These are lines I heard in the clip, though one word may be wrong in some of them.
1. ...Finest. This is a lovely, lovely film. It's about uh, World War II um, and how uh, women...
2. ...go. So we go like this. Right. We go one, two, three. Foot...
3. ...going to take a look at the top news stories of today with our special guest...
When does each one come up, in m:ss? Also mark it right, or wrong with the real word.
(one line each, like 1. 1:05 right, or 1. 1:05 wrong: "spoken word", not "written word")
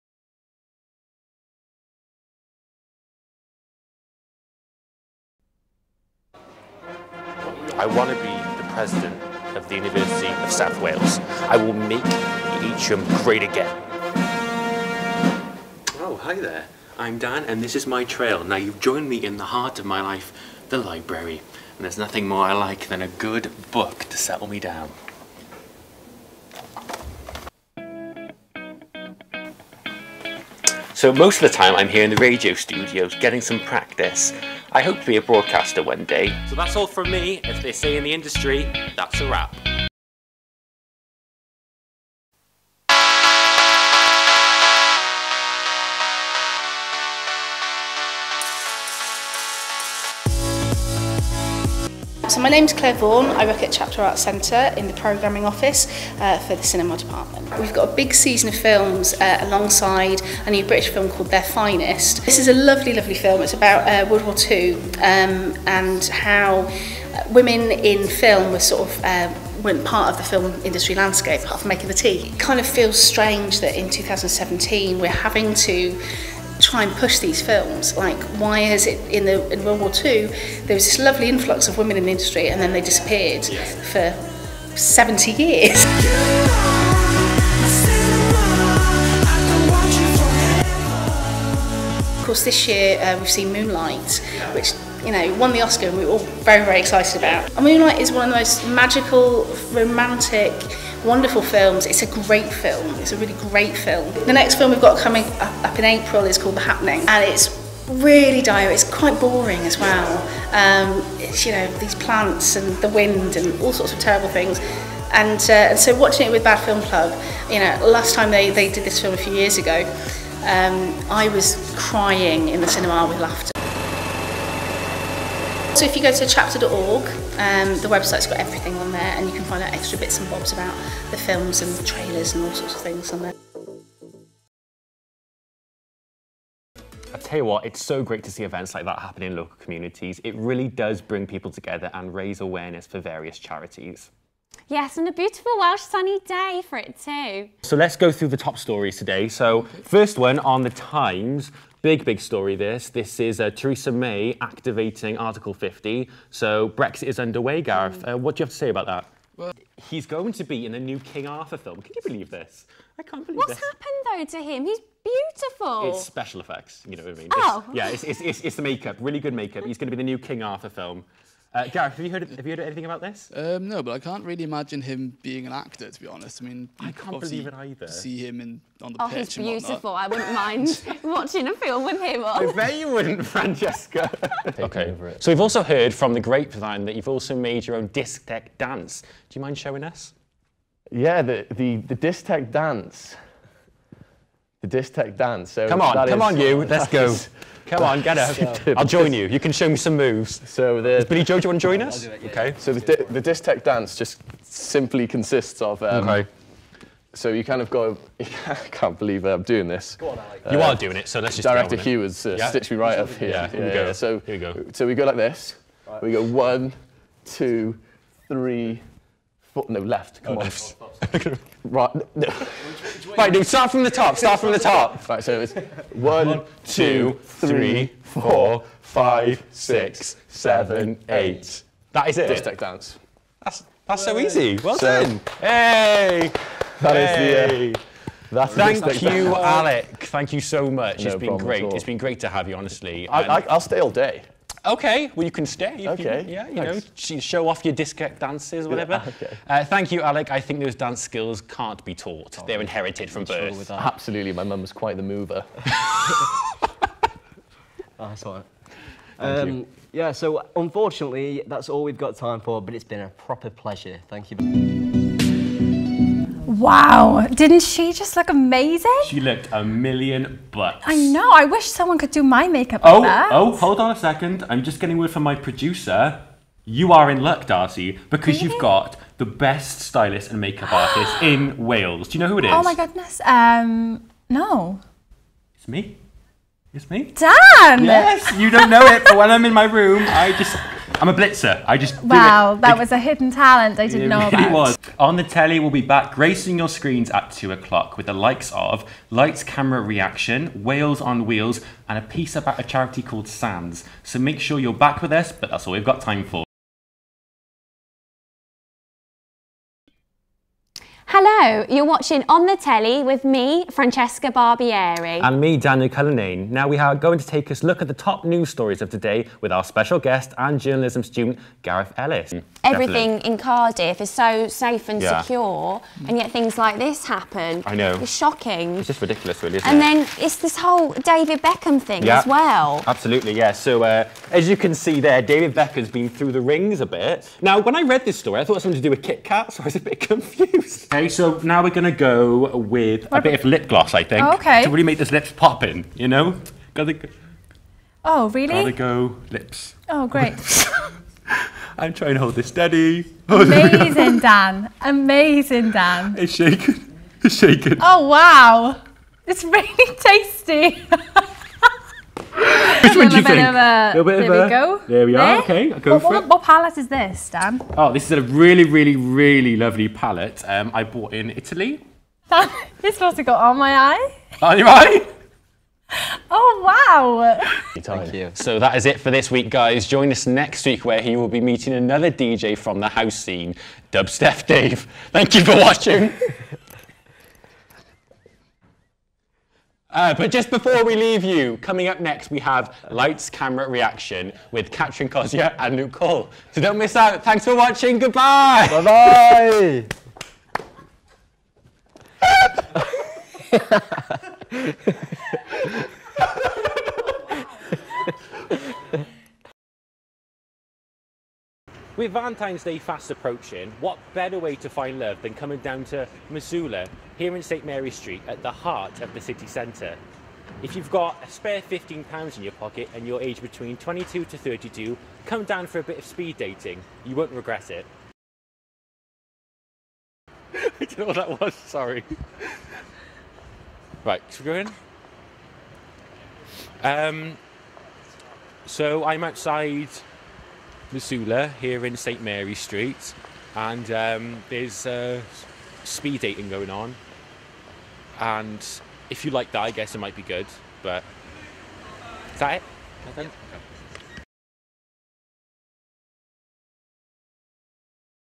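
1. 1:01 right
2. 3:34 right
3. 5:16 right.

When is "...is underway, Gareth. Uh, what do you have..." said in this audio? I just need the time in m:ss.
2:37.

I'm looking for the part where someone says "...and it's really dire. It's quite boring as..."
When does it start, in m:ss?
1:47.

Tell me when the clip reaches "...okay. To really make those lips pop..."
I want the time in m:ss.
5:44.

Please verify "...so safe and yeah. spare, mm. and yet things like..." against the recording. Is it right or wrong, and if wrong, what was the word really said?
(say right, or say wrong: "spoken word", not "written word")
wrong: "secure", not "spare".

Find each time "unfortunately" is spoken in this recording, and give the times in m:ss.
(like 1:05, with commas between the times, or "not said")
4:20.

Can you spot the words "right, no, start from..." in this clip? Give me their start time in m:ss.
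3:43.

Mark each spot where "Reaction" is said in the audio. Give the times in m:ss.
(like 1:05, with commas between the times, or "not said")
4:59, 6:33.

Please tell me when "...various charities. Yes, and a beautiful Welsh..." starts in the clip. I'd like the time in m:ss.
2:22.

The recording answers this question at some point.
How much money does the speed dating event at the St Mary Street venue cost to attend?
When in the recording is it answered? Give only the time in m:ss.
7:01.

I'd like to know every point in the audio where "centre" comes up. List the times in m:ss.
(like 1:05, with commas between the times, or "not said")
0:54, 6:59.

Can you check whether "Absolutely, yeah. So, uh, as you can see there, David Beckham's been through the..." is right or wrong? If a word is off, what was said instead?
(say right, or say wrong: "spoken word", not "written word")
right.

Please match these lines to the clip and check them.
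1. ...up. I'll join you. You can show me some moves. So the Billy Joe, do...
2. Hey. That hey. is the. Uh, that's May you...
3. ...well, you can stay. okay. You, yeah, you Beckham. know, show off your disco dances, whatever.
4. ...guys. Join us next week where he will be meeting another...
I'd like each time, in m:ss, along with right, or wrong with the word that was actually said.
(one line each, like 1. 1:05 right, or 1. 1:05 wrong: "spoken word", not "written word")
1. 3:18 right
2. 3:55 wrong: "Thank", not "May"
3. 4:05 wrong: "Thanks", not "Beckham"
4. 6:19 right.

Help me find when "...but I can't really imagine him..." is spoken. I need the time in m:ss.
2:53.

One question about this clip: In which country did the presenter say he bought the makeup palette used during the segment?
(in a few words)
Italy.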